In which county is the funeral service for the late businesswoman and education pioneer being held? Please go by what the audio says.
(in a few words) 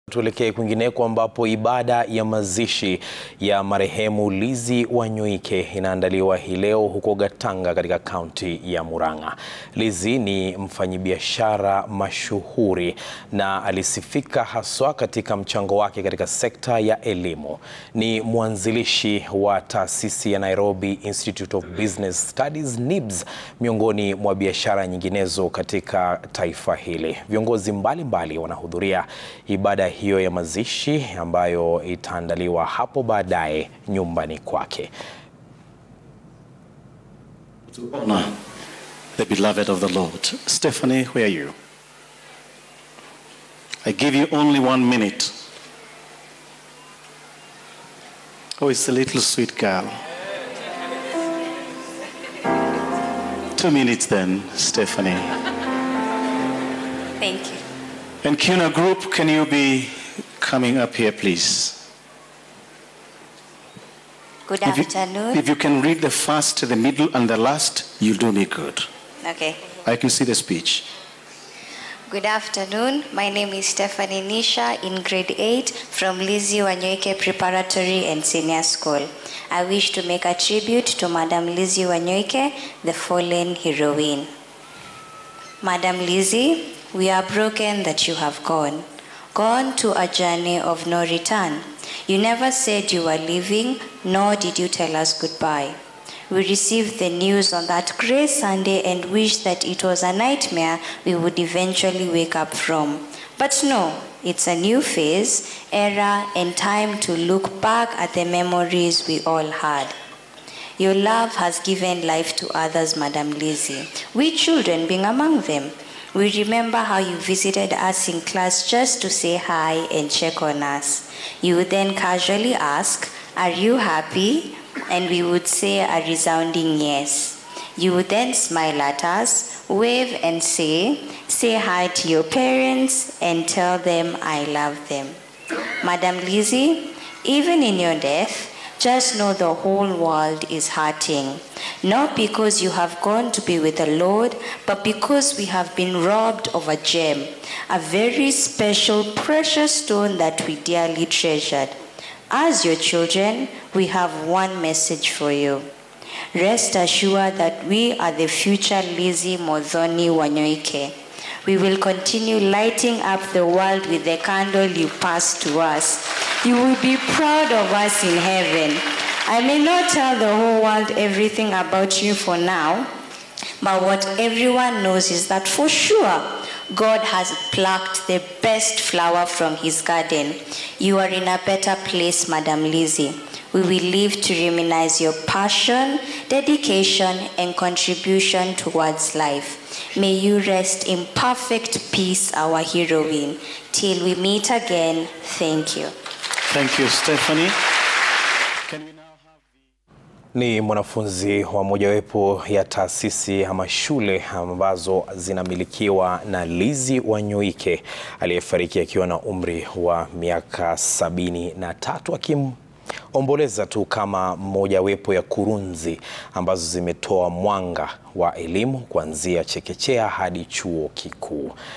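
Murang'a.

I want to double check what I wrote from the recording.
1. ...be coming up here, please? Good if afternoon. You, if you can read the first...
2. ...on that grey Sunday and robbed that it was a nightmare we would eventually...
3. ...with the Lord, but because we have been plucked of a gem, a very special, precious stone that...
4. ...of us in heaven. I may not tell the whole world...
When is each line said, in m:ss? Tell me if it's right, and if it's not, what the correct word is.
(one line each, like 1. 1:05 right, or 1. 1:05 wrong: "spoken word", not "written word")
1. 0:59 right
2. 1:37 wrong: "wished", not "robbed"
3. 2:23 wrong: "robbed", not "plucked"
4. 2:47 right.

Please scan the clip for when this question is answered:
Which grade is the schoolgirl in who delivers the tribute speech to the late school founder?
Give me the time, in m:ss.
1:15.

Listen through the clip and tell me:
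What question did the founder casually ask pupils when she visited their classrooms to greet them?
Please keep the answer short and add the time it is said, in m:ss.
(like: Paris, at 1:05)
Are you happy?, at 2:03.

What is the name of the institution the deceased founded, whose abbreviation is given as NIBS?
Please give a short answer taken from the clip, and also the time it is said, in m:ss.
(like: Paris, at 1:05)
Nairobi Institute of Business Studies, at 0:20.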